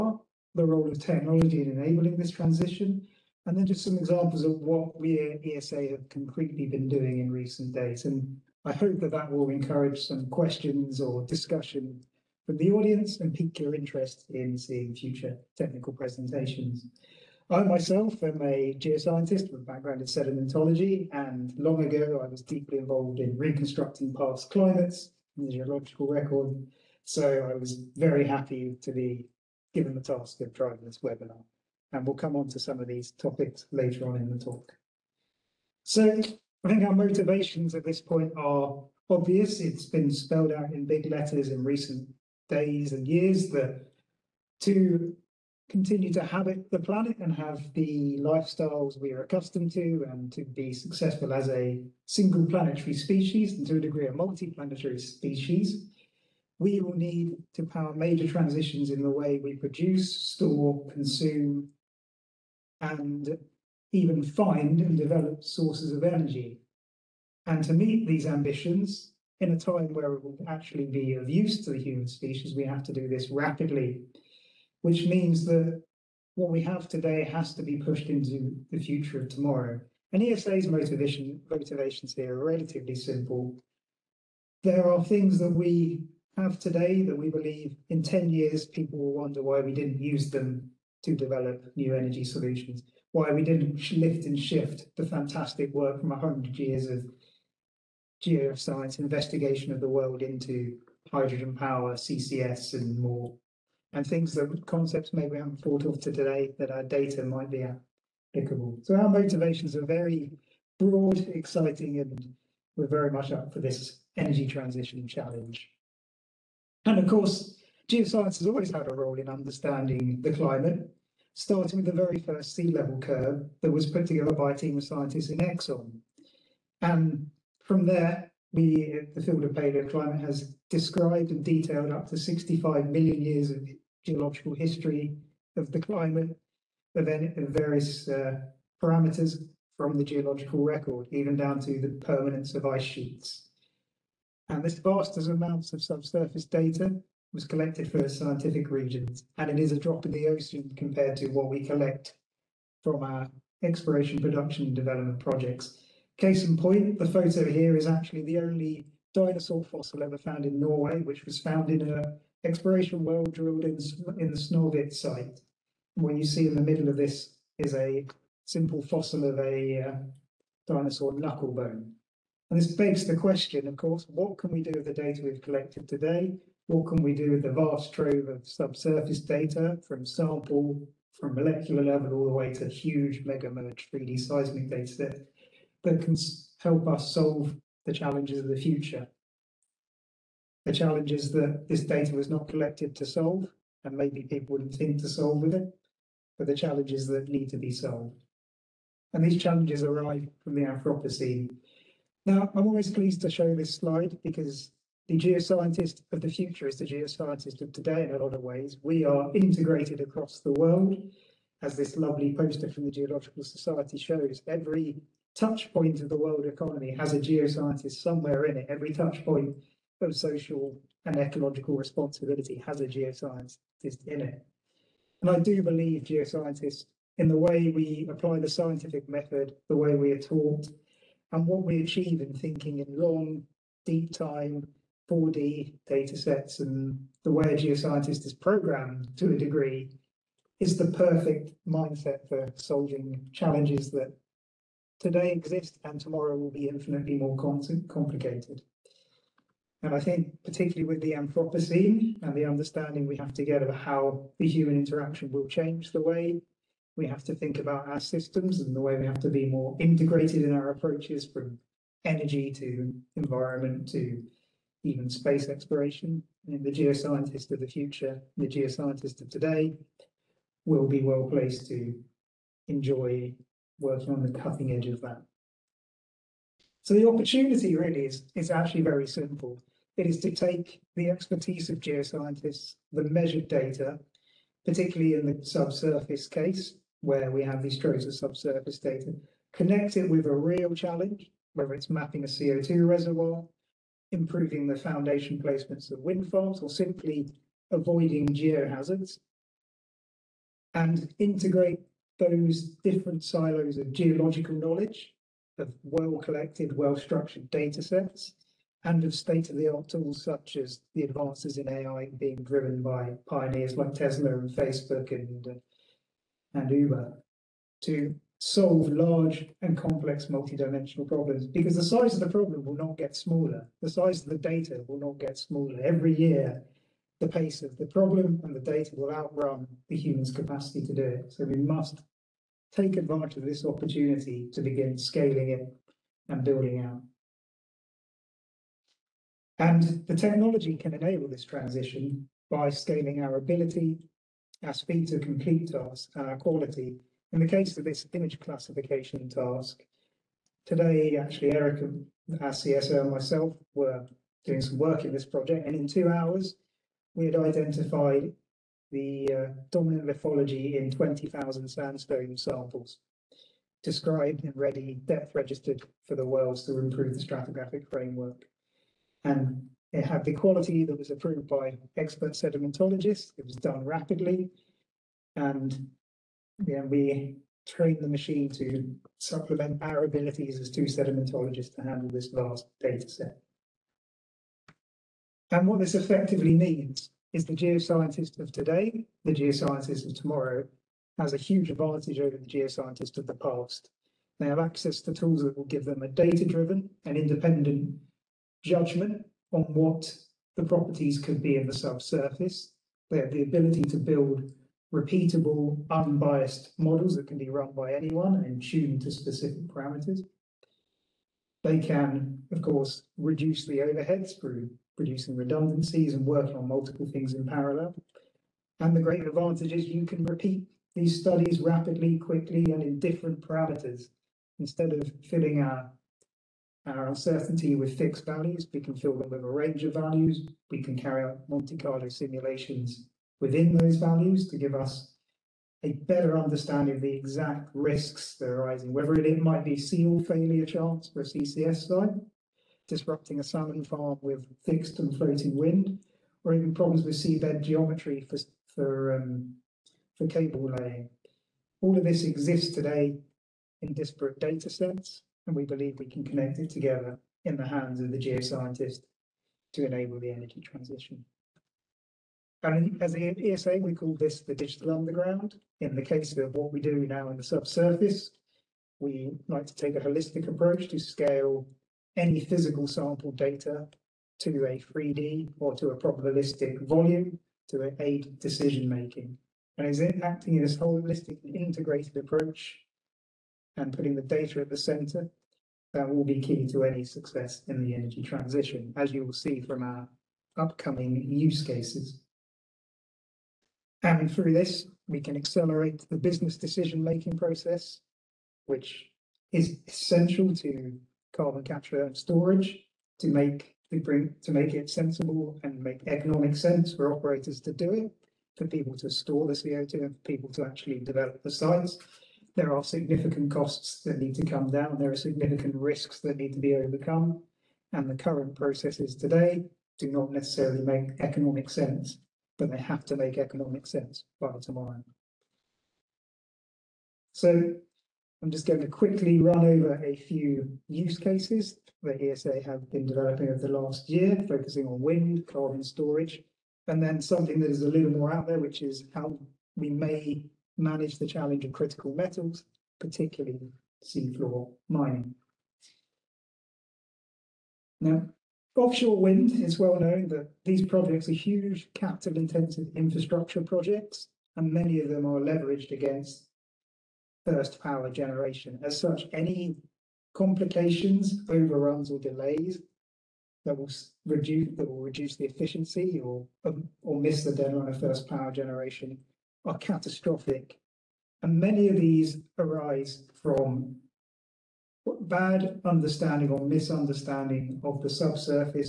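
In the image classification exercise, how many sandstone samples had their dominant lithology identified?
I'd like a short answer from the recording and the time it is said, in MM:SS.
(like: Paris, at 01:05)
20,000, at 06:00.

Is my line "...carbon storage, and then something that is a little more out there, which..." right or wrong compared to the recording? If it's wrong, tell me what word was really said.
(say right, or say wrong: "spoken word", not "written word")
right.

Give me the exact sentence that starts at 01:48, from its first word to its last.
So our motivations are very broad, exciting, and we're very much up for this energy transition challenge.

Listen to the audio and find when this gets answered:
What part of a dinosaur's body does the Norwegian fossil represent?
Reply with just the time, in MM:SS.
02:51.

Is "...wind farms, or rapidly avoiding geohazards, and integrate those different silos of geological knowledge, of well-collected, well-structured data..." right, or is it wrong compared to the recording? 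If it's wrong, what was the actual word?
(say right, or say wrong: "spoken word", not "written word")
wrong: "simply", not "rapidly".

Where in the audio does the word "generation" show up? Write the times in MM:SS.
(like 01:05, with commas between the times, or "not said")
09:18, 09:28.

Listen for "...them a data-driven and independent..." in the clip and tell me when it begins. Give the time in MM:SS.
06:35.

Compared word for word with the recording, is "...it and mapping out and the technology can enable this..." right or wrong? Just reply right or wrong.
wrong.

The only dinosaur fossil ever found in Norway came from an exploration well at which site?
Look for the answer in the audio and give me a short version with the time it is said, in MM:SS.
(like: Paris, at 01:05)
Snorvit, at 02:44.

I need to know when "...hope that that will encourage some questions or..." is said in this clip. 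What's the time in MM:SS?
00:08.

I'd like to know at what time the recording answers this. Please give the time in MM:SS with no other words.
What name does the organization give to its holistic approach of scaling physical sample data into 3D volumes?
07:44.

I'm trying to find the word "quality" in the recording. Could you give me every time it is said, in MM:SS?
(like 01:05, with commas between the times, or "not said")
05:46, 06:10.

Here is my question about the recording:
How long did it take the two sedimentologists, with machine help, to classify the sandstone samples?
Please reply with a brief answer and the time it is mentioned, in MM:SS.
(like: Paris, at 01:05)
2 hours, at 05:55.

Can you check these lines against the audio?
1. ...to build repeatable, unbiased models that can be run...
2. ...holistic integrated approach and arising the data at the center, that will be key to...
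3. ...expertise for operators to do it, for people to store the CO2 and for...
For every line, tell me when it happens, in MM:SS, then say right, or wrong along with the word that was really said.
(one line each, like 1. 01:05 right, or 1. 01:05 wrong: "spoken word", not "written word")
1. 06:43 right
2. 08:00 wrong: "putting", not "arising"
3. 08:26 wrong: "sense", not "expertise".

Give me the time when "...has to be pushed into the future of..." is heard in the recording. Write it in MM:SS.
01:17.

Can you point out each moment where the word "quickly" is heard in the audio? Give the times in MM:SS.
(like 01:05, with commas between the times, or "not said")
07:02, 08:48.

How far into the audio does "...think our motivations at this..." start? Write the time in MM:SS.
00:36.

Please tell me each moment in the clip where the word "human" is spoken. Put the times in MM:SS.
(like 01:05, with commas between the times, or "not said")
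01:11, 04:14, 05:29.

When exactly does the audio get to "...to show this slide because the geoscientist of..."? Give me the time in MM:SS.
03:23.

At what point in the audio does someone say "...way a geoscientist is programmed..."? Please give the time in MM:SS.
03:57.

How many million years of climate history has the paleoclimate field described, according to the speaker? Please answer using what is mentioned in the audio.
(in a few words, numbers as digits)
65 million years.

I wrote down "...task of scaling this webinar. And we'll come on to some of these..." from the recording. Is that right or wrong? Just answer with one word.
wrong.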